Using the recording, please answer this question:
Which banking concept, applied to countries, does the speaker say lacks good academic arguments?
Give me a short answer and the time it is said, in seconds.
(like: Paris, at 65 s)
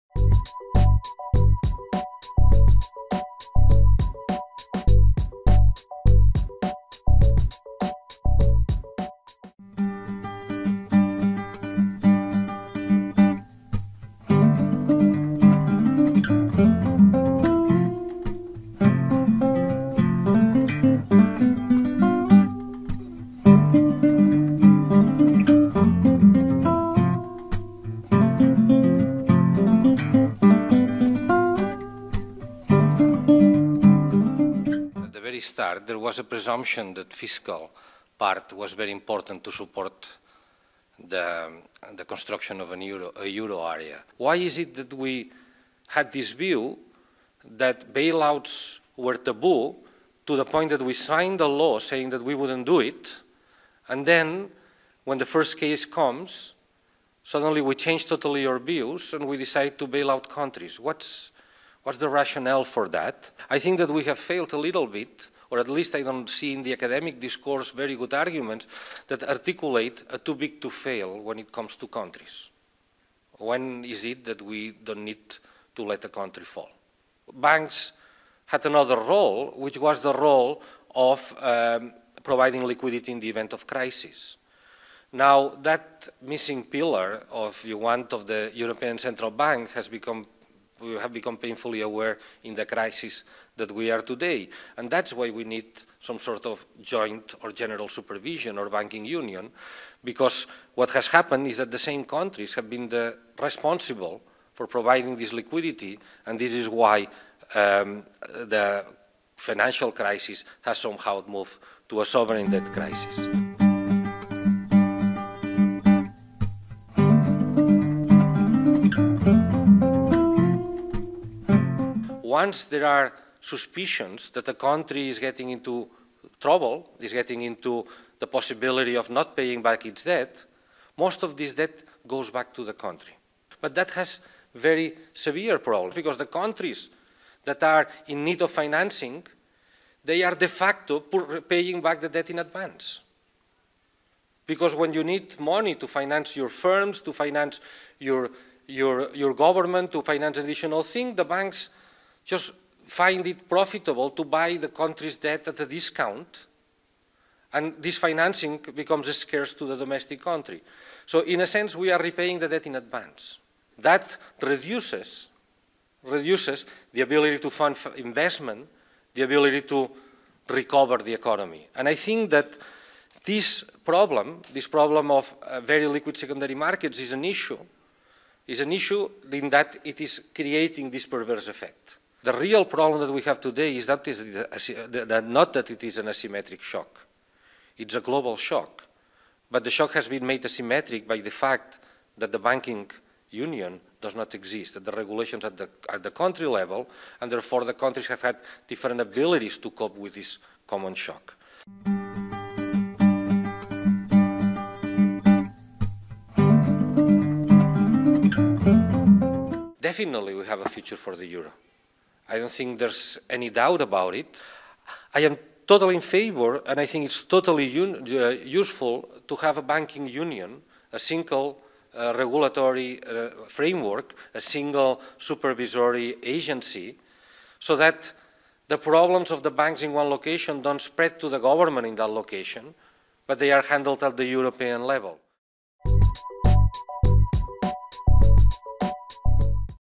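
Too big to fail, at 70 s.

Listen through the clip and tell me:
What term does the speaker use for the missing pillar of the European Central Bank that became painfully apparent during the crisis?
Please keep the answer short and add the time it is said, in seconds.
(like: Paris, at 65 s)
Providing liquidity, at 82 s.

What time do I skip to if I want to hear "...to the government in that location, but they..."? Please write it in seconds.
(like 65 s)
231 s.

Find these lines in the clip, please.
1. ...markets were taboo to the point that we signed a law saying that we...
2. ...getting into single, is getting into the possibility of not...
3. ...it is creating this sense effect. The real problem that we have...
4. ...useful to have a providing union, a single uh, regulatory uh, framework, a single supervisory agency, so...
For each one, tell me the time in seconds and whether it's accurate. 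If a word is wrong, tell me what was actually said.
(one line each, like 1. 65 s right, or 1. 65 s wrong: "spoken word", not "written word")
1. 47 s wrong: "bailouts", not "markets"
2. 125 s wrong: "trouble", not "single"
3. 179 s wrong: "perverse", not "sense"
4. 218 s wrong: "banking", not "providing".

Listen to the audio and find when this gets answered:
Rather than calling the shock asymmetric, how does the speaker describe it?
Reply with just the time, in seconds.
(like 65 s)
187 s.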